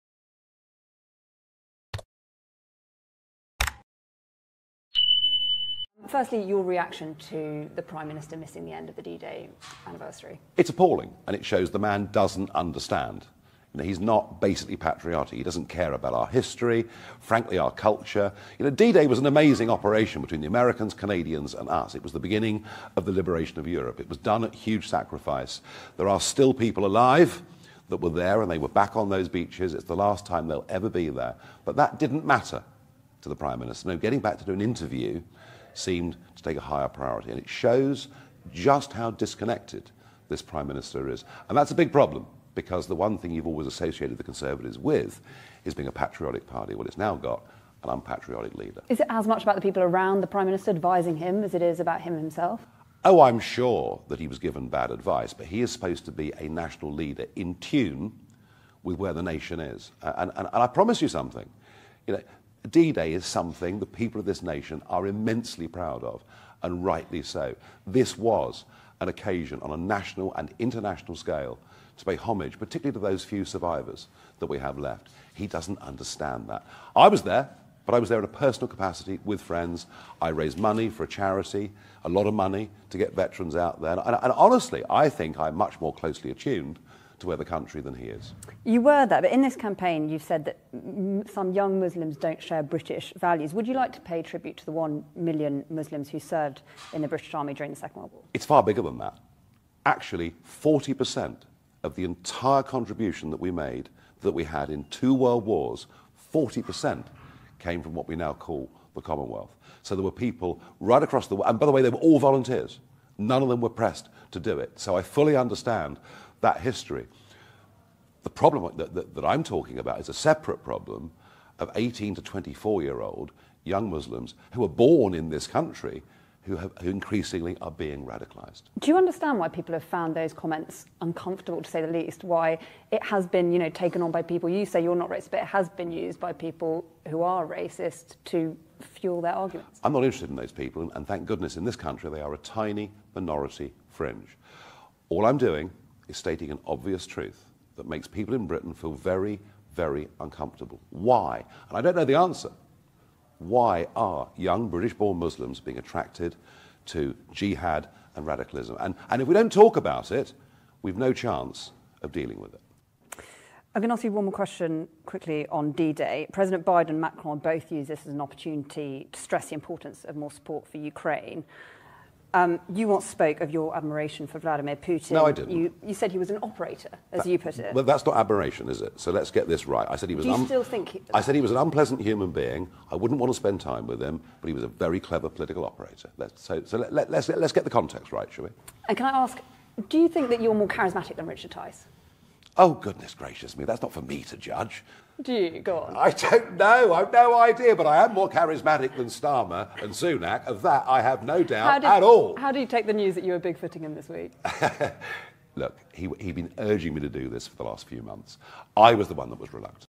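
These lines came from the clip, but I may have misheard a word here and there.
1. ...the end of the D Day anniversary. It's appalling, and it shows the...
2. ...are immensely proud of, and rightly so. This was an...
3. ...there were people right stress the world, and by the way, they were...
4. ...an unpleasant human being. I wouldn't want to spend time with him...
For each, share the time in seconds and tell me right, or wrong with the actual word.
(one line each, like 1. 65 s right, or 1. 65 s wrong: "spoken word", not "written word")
1. 8 s right
2. 64 s right
3. 109 s wrong: "across", not "stress"
4. 181 s right.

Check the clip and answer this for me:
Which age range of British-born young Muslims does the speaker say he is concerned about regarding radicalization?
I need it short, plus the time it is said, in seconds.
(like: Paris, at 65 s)
18 to 24, at 121 s.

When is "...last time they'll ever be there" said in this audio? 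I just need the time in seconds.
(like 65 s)
29 s.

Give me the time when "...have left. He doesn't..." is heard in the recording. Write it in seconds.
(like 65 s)
74 s.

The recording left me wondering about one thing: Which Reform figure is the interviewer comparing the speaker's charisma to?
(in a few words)
Richard Tice.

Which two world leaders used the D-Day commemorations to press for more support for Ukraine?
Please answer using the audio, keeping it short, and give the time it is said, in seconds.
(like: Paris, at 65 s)
Biden and Macron, at 166 s.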